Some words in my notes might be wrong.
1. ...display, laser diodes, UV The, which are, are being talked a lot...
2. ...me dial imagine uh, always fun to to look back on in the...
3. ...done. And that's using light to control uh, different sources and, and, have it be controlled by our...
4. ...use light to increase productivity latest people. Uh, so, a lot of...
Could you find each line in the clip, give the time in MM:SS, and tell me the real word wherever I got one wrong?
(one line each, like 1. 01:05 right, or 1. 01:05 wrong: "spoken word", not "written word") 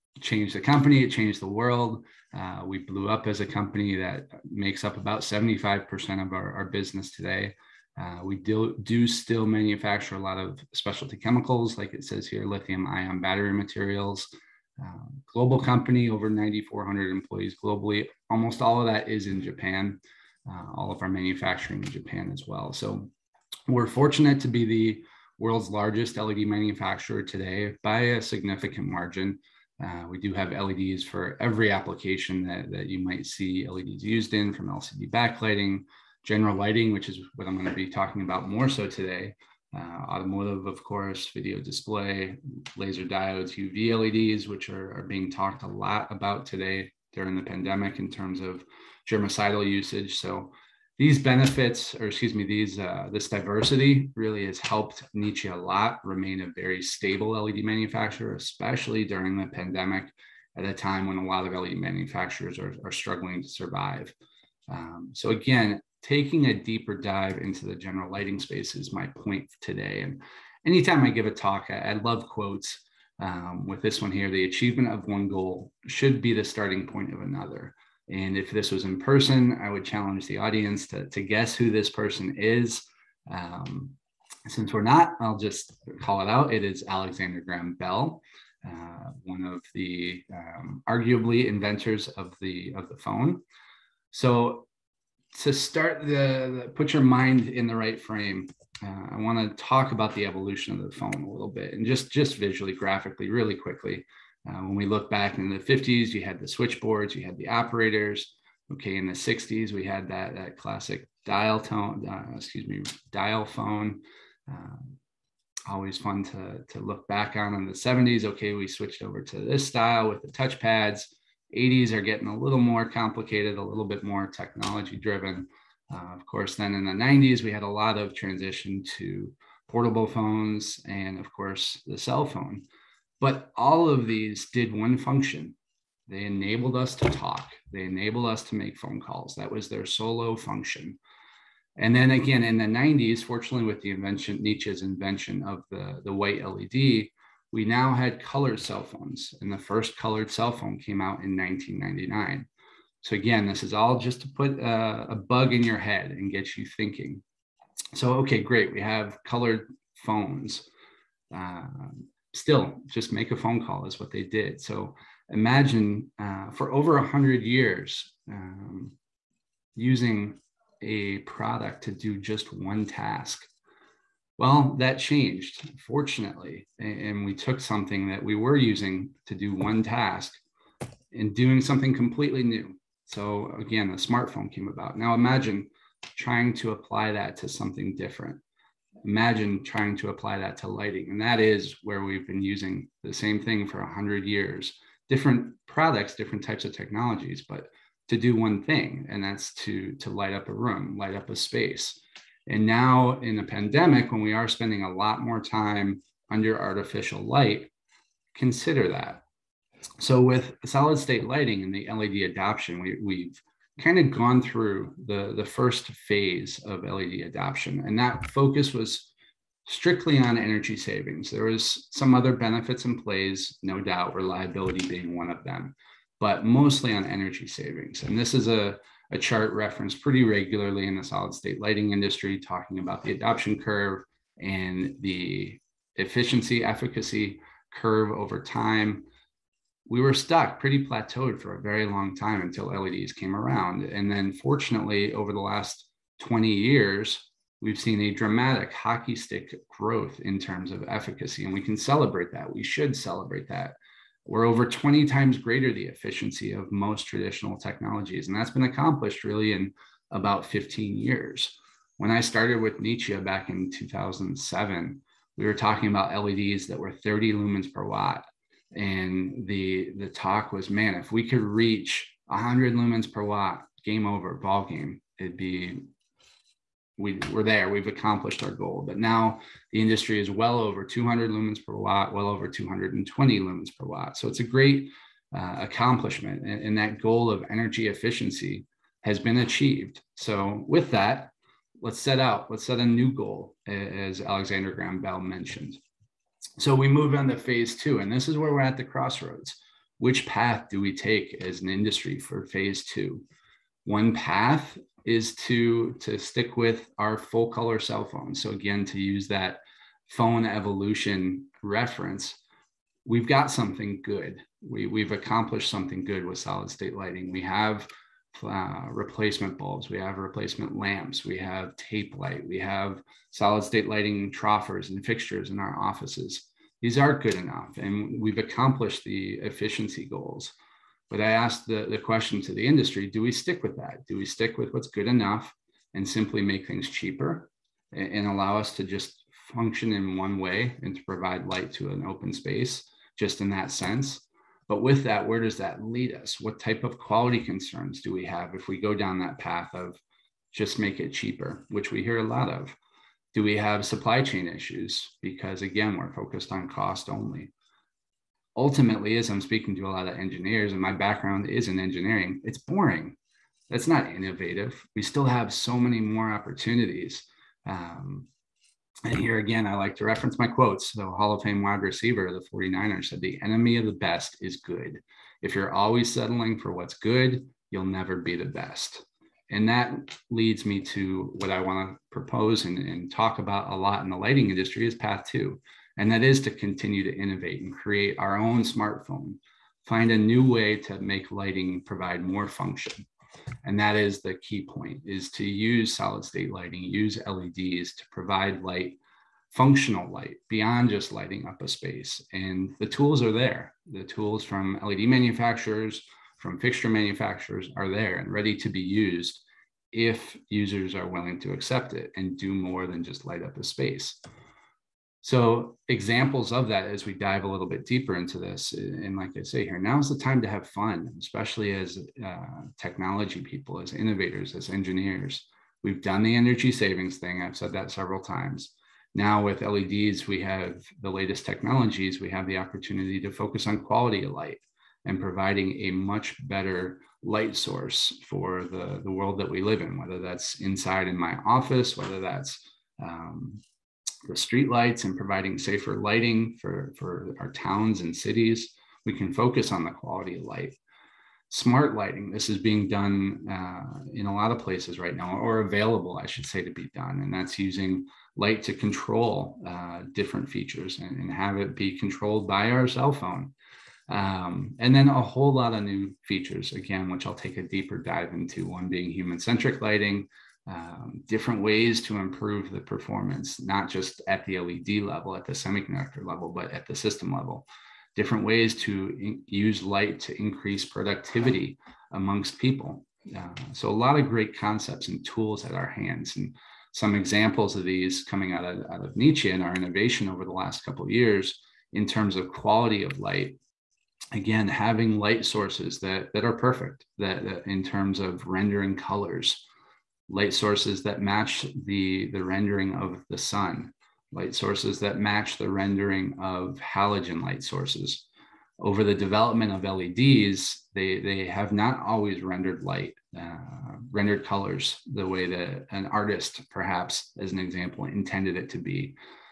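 1. 00:41 wrong: "LEDs", not "The"
2. 01:52 wrong: "phone", not "imagine"
3. 07:36 wrong: "features", not "sources"
4. 07:59 wrong: "amongst", not "latest".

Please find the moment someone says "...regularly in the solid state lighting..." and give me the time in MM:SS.
03:50.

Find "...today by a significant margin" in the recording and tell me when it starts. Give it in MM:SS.
00:27.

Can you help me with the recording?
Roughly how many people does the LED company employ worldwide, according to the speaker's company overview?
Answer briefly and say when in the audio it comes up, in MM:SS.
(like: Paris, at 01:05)
9,400, at 00:16.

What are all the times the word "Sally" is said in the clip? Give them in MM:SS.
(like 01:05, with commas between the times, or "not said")
not said.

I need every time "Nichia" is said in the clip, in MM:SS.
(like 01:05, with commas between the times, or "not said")
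00:55, 02:24, 04:22, 08:09.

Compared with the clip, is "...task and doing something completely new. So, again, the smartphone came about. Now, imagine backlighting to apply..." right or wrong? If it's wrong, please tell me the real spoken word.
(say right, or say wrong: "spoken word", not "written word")
wrong: "trying", not "backlighting".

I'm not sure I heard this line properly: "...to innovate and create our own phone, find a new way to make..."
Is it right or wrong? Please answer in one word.
wrong.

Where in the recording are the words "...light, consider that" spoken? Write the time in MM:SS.
03:27.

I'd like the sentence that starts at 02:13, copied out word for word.
But all of these did one function they enabled us to talk, they enabled us to make phone calls.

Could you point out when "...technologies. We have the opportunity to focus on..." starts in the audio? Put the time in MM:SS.
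07:11.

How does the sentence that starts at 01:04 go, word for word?
Um, so again, taking a deeper dive into the general lighting space is my point today.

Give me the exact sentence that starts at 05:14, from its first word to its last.
We we've accomplished something good with solid state lighting.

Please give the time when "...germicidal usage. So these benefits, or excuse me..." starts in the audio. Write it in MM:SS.
00:49.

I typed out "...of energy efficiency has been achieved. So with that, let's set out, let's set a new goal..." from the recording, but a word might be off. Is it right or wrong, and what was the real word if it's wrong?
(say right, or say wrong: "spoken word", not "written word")
right.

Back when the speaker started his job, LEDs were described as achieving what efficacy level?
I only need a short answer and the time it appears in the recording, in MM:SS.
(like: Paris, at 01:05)
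30 lumens per watt, at 04:26.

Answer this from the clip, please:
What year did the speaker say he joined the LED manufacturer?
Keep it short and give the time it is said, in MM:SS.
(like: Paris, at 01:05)
2007, at 04:23.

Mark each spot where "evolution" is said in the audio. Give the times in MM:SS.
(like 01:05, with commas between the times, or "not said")
01:40, 05:10.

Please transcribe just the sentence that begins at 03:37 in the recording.
And that focus was strictly on energy savings.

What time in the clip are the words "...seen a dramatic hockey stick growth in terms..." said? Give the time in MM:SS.
04:07.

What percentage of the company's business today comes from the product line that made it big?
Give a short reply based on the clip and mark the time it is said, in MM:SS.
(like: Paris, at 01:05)
75%, at 00:05.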